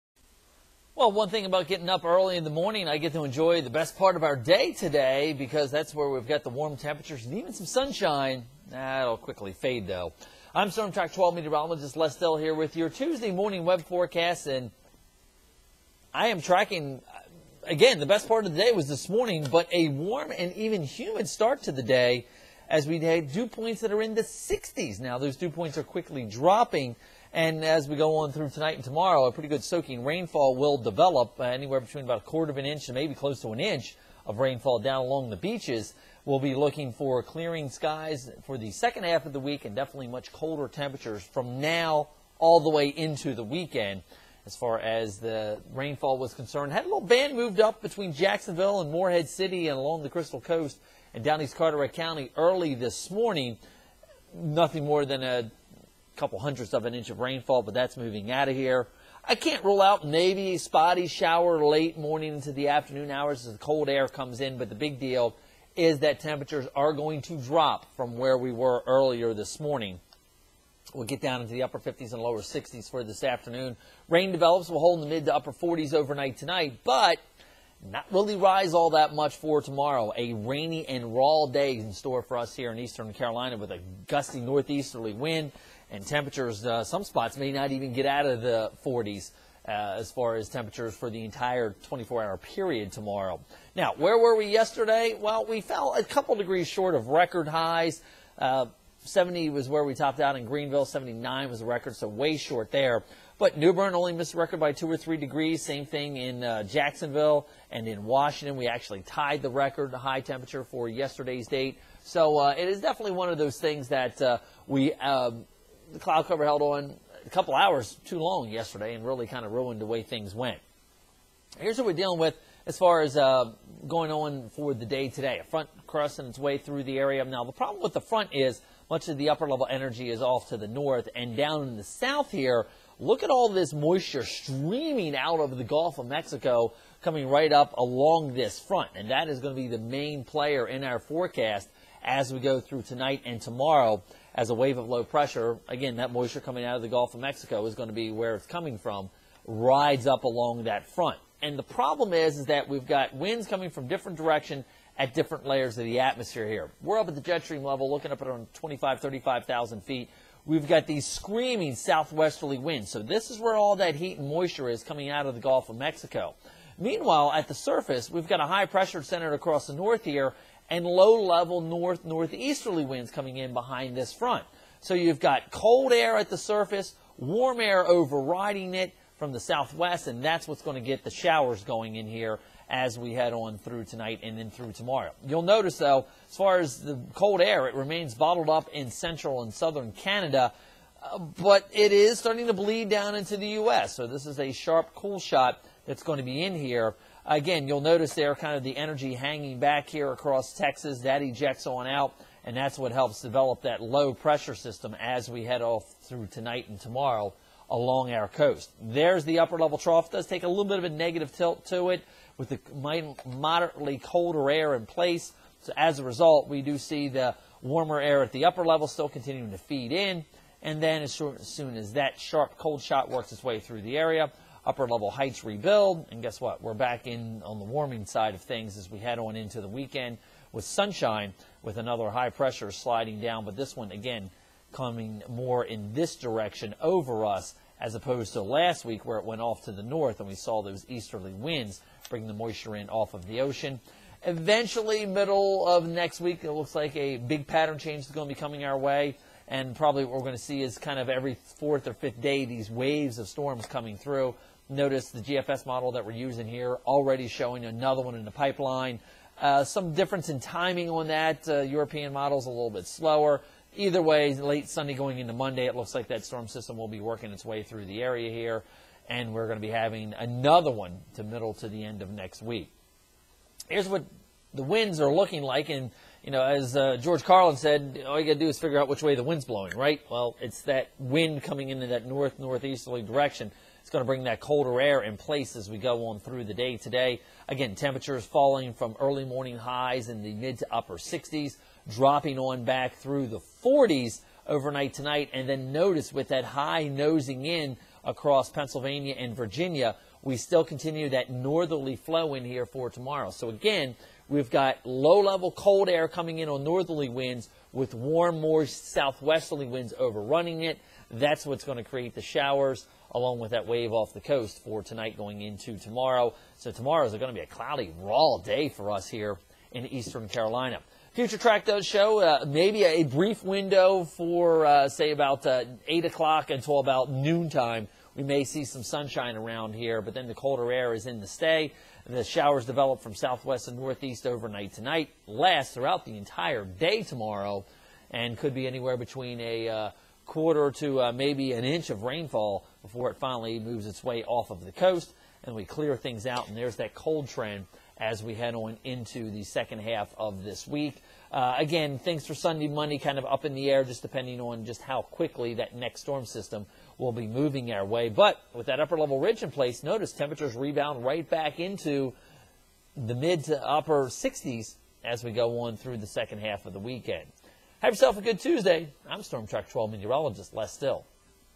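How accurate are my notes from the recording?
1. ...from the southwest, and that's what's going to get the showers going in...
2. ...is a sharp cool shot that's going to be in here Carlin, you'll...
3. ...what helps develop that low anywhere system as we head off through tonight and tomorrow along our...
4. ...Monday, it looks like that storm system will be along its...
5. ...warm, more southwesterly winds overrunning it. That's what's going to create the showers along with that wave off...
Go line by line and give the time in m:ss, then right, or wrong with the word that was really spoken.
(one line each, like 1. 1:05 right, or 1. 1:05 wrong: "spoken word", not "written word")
1. 2:59 right
2. 3:14 wrong: "Again", not "Carlin"
3. 3:22 wrong: "pressure", not "anywhere"
4. 4:25 wrong: "working", not "along"
5. 5:07 right.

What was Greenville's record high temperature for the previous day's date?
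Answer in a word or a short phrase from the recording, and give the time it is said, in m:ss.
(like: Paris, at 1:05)
79, at 1:40.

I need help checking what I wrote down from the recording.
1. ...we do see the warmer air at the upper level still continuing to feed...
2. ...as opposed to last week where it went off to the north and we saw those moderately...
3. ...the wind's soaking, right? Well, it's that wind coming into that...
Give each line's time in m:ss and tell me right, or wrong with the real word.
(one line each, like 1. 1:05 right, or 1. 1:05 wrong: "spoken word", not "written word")
1. 3:36 right
2. 3:57 wrong: "easterly", not "moderately"
3. 4:39 wrong: "blowing", not "soaking".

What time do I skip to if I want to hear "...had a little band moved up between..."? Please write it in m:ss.
0:46.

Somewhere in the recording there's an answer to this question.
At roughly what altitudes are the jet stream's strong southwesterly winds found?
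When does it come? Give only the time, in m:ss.
2:38.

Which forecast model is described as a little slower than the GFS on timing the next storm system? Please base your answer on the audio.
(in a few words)
European model.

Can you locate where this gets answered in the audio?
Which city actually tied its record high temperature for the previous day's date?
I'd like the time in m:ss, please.
1:48.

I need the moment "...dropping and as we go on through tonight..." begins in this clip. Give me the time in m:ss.
0:26.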